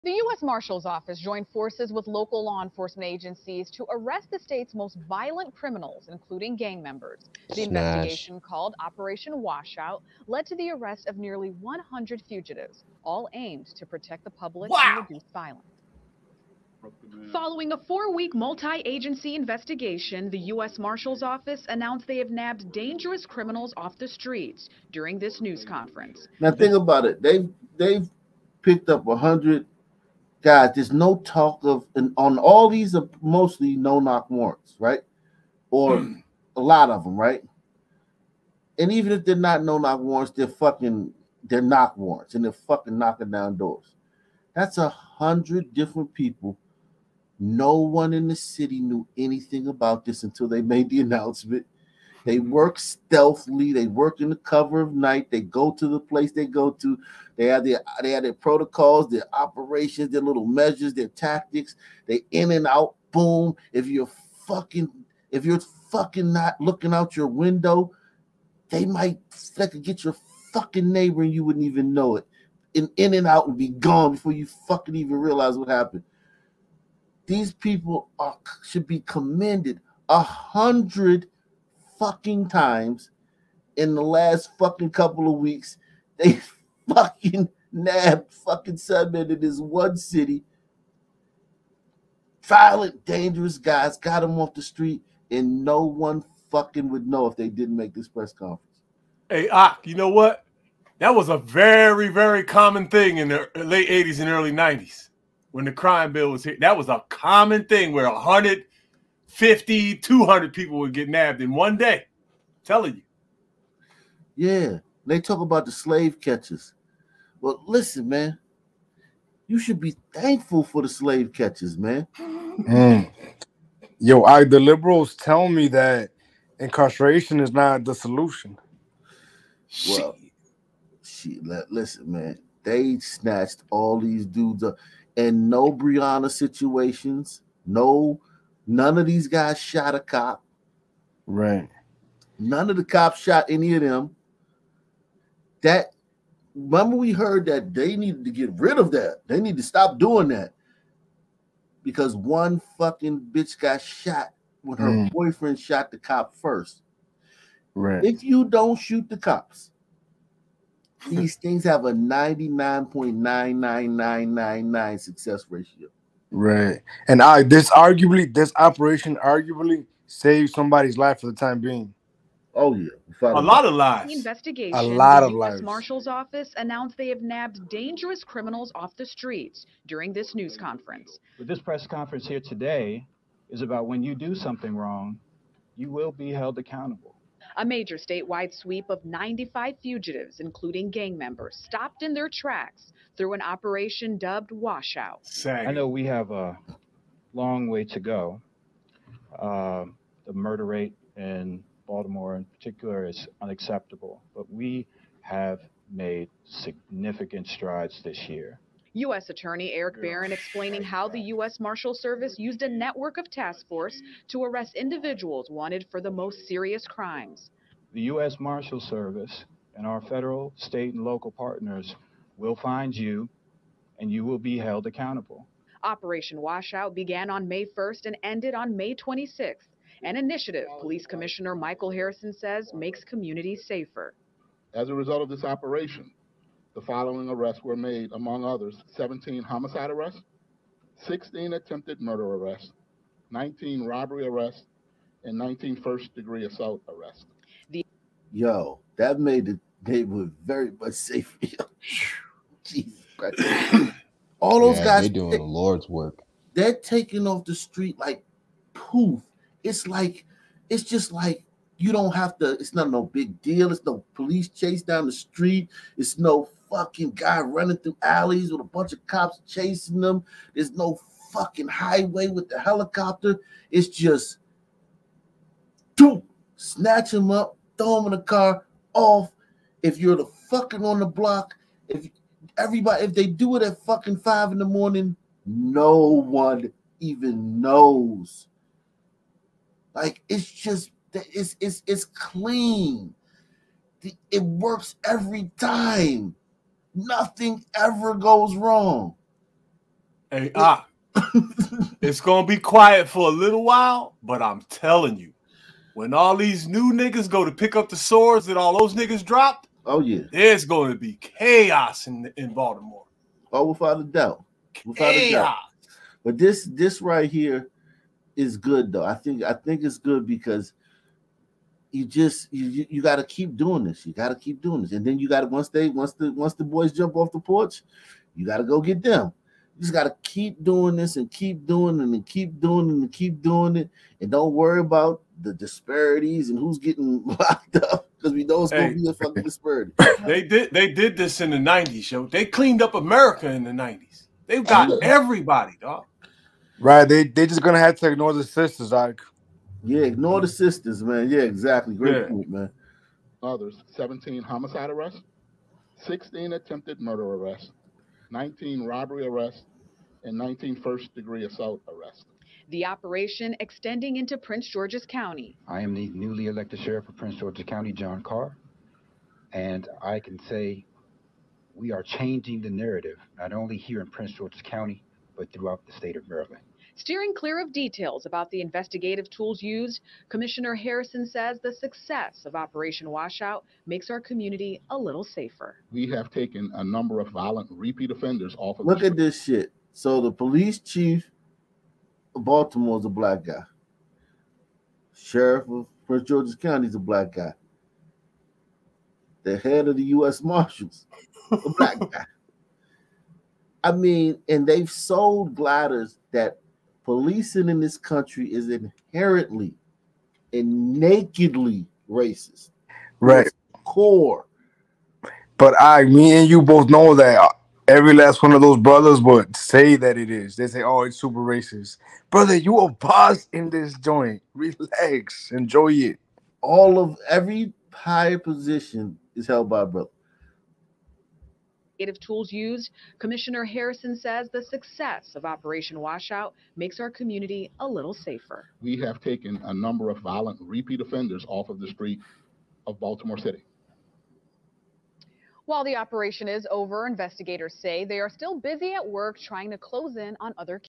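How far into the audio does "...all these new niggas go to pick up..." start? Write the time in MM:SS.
05:06.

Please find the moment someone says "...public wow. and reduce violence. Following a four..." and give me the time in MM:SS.
00:14.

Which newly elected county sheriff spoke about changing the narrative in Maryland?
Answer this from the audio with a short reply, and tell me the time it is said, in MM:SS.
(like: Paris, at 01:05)
John Carr, at 06:07.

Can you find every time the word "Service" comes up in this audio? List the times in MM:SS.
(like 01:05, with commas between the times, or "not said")
03:31, 03:38.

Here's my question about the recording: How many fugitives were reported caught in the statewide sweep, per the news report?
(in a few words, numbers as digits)
95.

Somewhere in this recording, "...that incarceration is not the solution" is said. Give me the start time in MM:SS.
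02:05.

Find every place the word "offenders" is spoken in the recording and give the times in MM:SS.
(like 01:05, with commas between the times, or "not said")
06:28, 07:21.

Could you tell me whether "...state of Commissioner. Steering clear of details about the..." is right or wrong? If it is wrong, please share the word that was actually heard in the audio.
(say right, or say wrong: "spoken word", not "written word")
wrong: "Maryland", not "Commissioner".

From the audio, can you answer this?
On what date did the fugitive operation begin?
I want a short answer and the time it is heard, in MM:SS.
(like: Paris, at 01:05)
May 1st, at 03:47.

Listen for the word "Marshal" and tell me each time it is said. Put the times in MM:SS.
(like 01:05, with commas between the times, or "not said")
00:00, 00:20, 02:55, 03:31, 03:38, 06:40.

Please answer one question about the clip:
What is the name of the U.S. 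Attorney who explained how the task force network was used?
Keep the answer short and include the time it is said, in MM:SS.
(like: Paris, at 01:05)
Erek Barron, at 03:29.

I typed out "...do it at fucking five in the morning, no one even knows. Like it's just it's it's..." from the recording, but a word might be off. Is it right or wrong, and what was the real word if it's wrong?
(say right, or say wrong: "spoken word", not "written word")
right.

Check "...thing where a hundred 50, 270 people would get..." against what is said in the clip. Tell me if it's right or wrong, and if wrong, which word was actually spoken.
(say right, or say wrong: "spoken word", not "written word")
wrong: "200", not "270".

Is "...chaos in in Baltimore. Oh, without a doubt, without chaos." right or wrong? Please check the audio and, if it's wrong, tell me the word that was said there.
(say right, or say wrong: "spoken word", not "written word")
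right.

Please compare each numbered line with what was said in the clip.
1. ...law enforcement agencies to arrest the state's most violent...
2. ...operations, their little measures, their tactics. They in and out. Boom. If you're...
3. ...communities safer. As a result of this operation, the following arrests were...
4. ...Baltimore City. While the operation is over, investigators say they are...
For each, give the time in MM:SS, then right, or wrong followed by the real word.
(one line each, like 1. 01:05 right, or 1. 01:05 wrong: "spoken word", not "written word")
1. 00:02 right
2. 00:59 right
3. 03:53 right
4. 07:22 right.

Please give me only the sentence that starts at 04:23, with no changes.
It's no police chase down the street.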